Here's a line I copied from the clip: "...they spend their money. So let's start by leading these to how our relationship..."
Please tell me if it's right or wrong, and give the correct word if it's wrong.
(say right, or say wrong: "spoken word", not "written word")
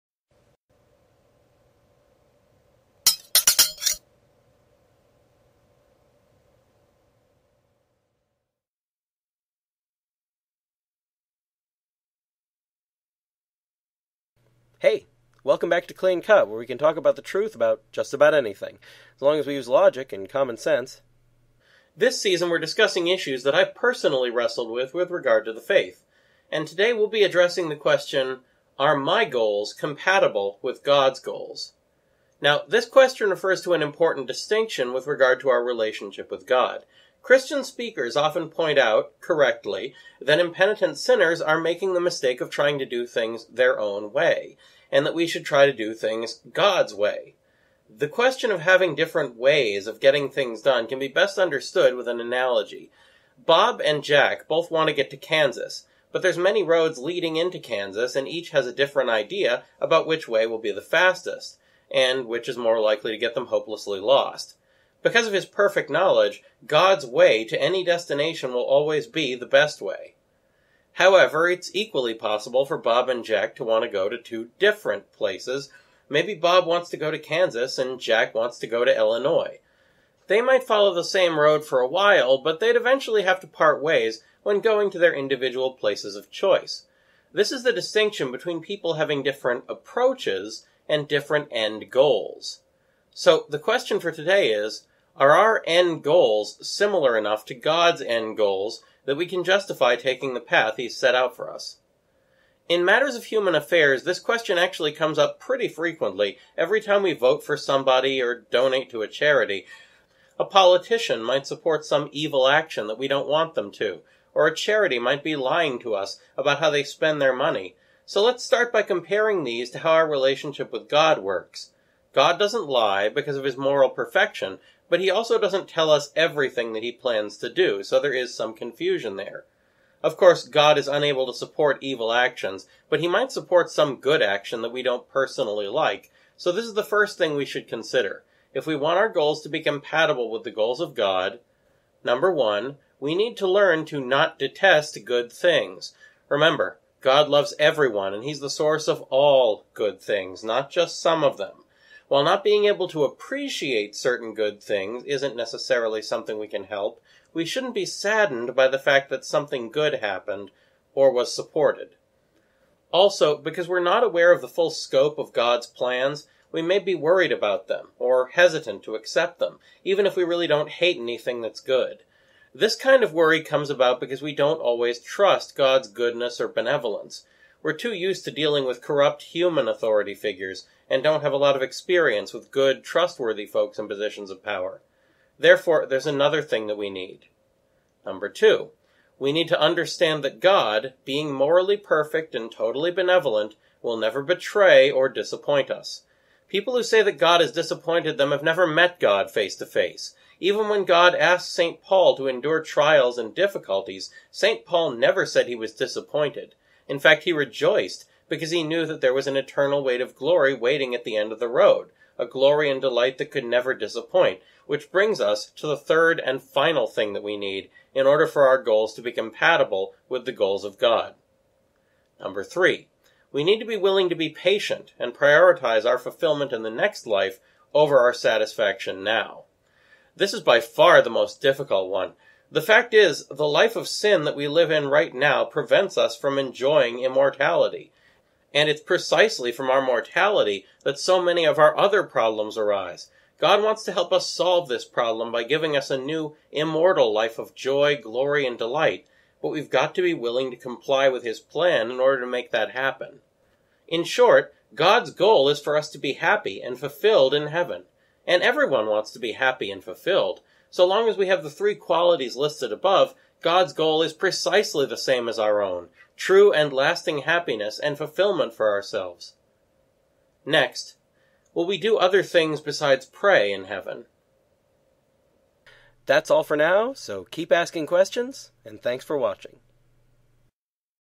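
wrong: "comparing", not "leading".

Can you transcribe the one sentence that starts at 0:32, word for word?
Now, this question refers to an important distinction with regard to our relationship with God.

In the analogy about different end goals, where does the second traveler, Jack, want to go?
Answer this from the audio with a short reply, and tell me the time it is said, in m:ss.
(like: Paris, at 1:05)
Illinois, at 1:18.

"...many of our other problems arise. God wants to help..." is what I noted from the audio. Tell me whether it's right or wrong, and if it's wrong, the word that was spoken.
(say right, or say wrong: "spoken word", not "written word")
right.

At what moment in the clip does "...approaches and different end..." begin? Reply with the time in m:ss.
1:29.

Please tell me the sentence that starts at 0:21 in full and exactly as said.
This season, we're discussing issues that I've personally wrestled with with regard to the faith.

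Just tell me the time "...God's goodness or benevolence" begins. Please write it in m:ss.
2:55.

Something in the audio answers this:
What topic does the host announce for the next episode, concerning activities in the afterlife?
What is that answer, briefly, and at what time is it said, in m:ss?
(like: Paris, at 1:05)
Other things besides pray in heaven, at 4:31.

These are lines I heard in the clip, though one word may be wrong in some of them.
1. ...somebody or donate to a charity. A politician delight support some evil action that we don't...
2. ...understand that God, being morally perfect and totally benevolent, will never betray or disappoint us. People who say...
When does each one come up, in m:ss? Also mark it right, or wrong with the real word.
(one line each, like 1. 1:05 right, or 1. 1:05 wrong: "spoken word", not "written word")
1. 1:47 wrong: "might", not "delight"
2. 3:09 right.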